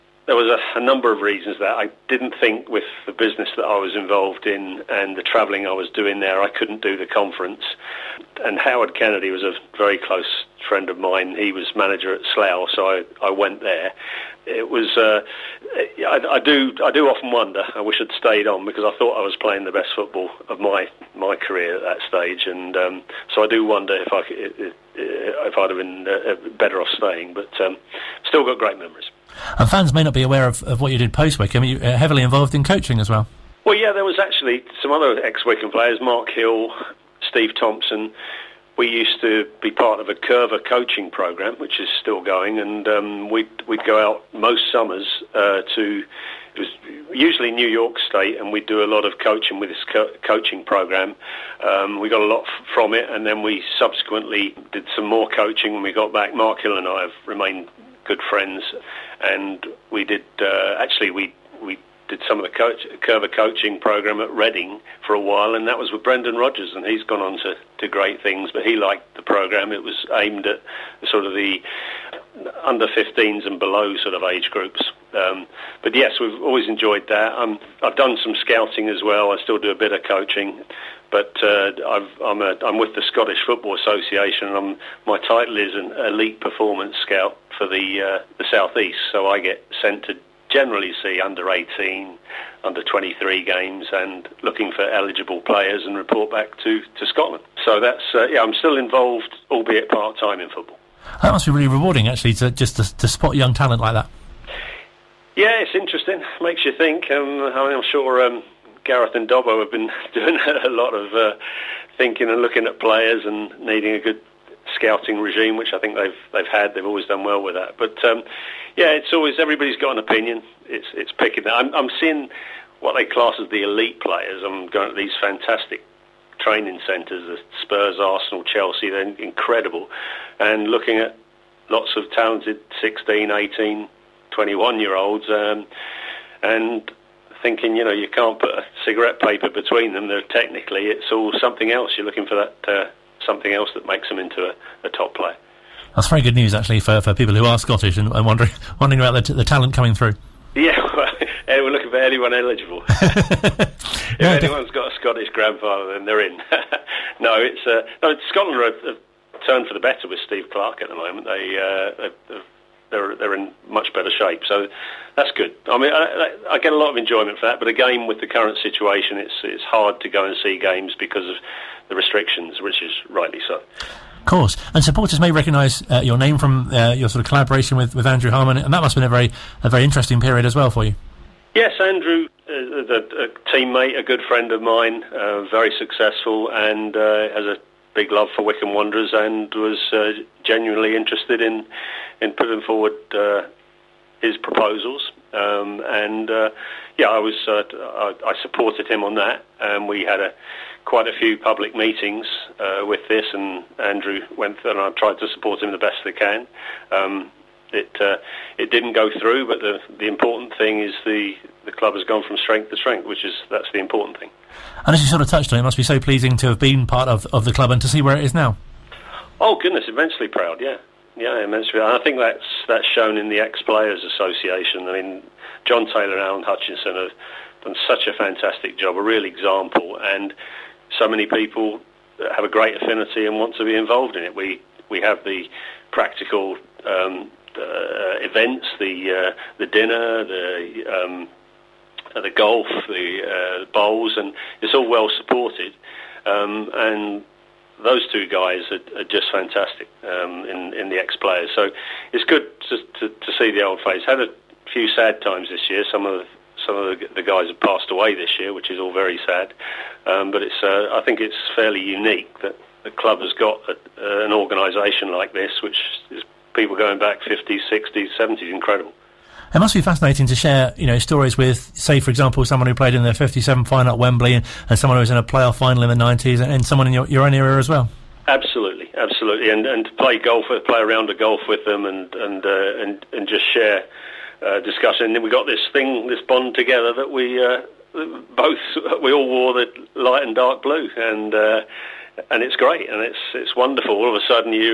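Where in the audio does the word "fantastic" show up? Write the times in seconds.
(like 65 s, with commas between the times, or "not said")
125 s, 228 s, 249 s.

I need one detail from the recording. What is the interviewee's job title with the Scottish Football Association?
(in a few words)
Elite performance scout.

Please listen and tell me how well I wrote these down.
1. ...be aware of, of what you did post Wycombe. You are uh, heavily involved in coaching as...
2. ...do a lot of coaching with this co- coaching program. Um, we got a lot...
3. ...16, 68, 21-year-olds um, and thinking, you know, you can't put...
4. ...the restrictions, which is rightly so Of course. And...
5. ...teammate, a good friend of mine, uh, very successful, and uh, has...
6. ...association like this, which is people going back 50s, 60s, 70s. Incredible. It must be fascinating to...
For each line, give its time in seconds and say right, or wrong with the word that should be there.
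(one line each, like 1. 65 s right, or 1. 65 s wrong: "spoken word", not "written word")
1. 30 s right
2. 48 s right
3. 132 s wrong: "18", not "68"
4. 171 s right
5. 183 s right
6. 264 s wrong: "organisation", not "association".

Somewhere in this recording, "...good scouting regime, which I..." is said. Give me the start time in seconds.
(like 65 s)
113 s.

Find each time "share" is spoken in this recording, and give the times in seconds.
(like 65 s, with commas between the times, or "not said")
270 s, 283 s.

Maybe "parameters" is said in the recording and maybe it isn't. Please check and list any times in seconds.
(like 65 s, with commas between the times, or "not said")
not said.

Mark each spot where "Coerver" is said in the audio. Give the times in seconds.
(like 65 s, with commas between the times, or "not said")
40 s, 63 s.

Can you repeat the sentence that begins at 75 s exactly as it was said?
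Um, but yes, we've always enjoyed that.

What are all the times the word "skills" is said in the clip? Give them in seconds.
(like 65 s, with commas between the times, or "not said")
not said.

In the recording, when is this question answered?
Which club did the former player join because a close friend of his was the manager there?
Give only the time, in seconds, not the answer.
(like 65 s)
12 s.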